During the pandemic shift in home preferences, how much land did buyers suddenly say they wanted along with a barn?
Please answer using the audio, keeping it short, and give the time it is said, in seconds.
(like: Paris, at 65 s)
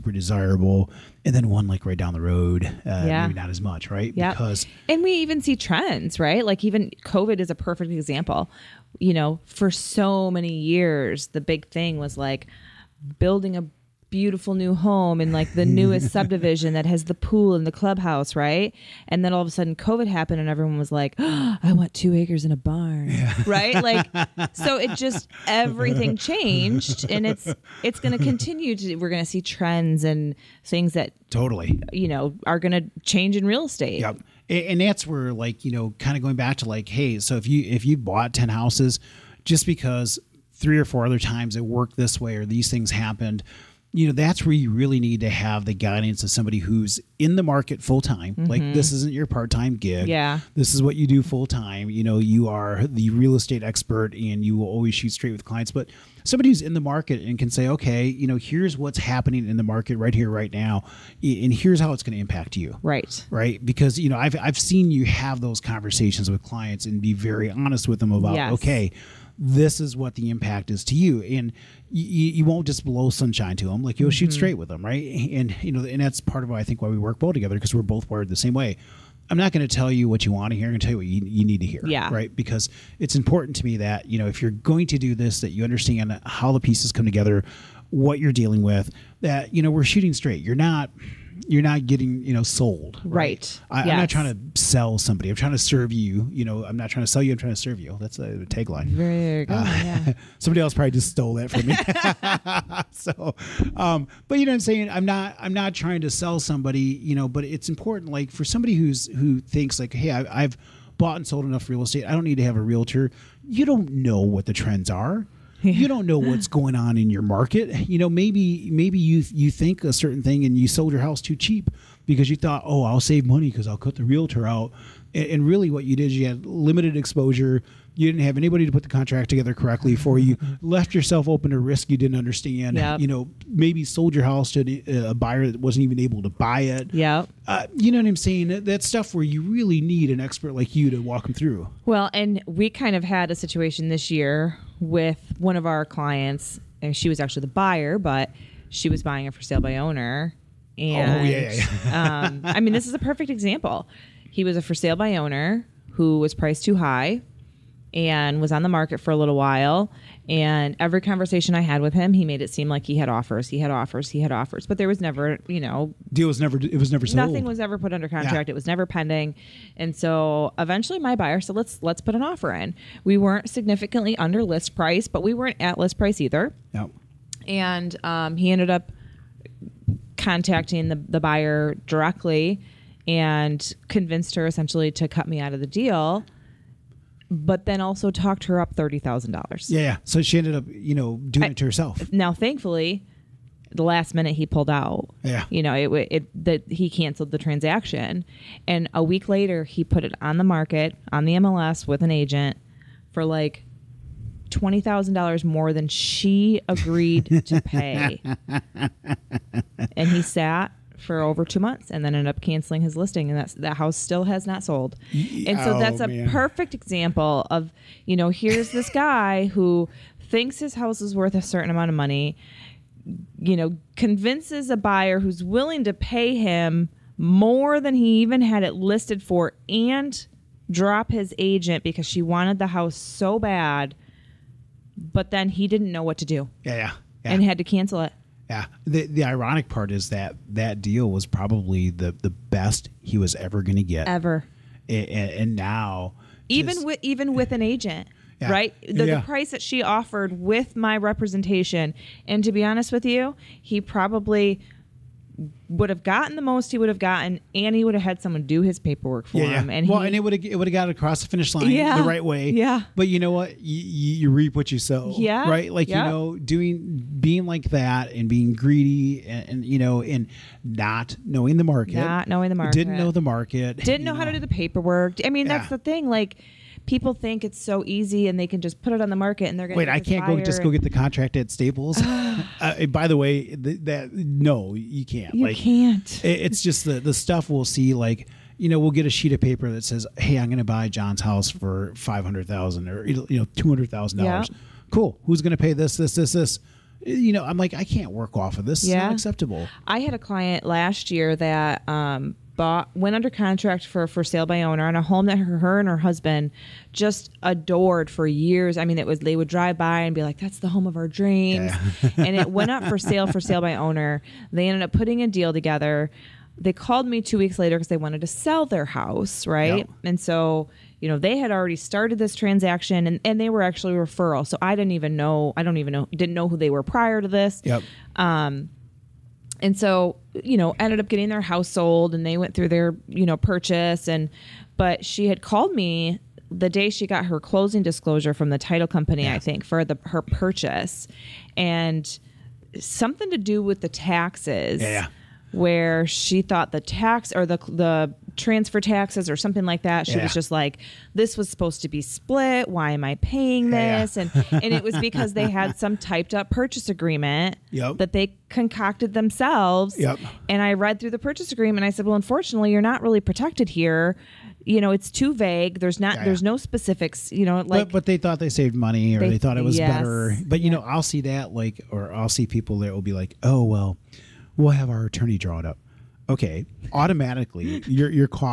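2 acres, at 21 s.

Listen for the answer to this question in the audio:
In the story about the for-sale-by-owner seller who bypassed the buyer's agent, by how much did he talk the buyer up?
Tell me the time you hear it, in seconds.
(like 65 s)
188 s.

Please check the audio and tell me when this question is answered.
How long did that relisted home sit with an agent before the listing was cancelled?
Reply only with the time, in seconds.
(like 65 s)
211 s.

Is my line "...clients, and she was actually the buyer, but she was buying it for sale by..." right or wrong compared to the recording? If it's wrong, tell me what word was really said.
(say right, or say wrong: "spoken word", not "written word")
right.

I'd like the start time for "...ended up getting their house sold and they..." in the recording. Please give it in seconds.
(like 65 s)
330 s.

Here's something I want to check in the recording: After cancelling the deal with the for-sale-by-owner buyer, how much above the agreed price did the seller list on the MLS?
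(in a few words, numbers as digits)
$20,000.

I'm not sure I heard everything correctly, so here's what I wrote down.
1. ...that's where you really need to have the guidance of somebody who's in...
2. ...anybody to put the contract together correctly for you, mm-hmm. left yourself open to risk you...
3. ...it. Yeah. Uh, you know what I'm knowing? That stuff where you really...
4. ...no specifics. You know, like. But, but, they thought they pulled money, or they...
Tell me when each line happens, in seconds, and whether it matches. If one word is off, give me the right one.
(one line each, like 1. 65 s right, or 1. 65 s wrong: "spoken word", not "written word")
1. 44 s right
2. 128 s right
3. 136 s wrong: "saying", not "knowing"
4. 366 s wrong: "saved", not "pulled".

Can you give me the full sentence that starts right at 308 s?
I mean, it was they would drive by and be like, "That's the home of our dreams," yeah.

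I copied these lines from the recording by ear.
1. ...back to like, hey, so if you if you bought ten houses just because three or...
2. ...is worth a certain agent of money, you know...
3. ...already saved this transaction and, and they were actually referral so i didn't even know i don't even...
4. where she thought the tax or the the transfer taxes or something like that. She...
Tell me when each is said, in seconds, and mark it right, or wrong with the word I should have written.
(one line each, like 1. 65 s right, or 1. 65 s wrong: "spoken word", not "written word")
1. 36 s right
2. 221 s wrong: "amount", not "agent"
3. 321 s wrong: "started", not "saved"
4. 345 s right.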